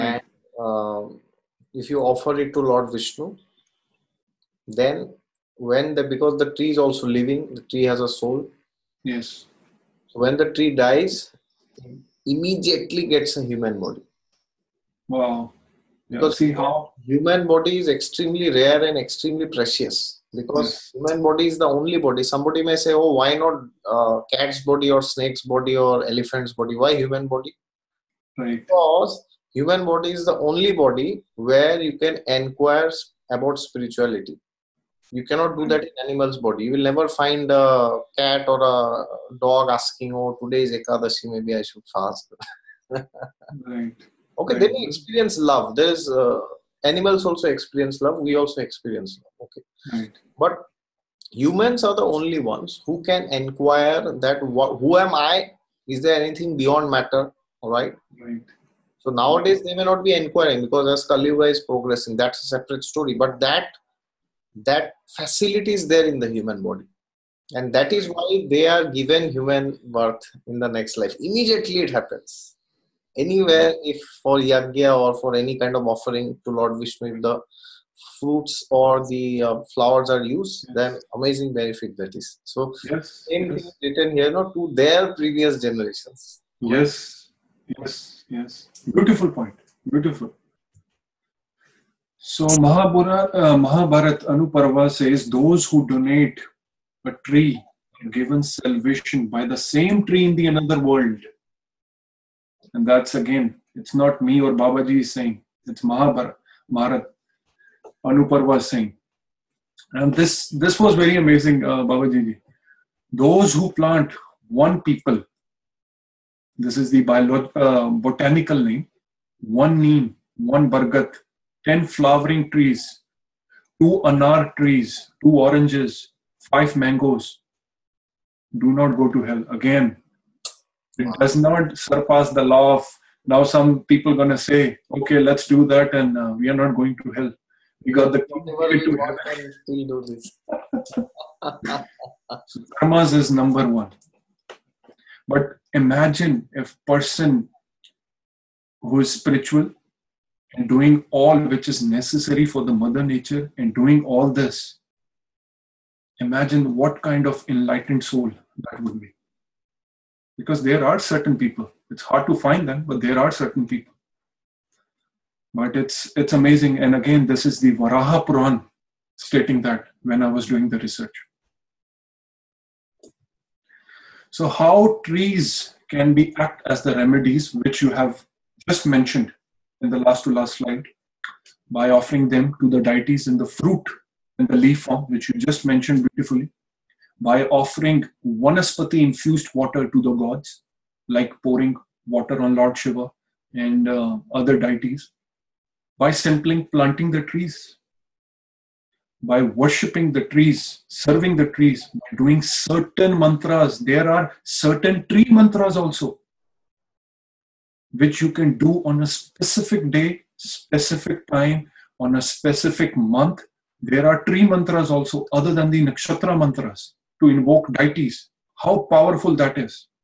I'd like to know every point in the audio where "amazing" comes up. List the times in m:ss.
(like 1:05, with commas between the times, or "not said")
1:21, 1:51, 2:46.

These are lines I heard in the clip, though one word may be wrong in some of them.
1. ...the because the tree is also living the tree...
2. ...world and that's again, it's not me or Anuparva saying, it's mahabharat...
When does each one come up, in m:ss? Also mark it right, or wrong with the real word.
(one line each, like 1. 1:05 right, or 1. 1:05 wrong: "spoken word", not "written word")
1. 0:05 right
2. 1:40 wrong: "Babaji", not "Anuparva".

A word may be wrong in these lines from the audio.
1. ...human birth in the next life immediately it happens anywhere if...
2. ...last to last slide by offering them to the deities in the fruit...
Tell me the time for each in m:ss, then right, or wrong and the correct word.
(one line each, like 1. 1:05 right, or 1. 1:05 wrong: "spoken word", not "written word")
1. 1:09 right
2. 2:59 right.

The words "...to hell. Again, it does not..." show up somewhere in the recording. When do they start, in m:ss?
2:09.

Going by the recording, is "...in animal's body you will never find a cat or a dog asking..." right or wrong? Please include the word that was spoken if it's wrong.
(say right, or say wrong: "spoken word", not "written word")
right.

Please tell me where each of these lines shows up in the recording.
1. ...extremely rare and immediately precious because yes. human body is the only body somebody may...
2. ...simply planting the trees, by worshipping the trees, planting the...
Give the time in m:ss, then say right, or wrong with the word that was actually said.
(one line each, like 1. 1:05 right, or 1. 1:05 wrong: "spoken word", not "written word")
1. 0:17 wrong: "extremely", not "immediately"
2. 3:16 wrong: "serving", not "planting".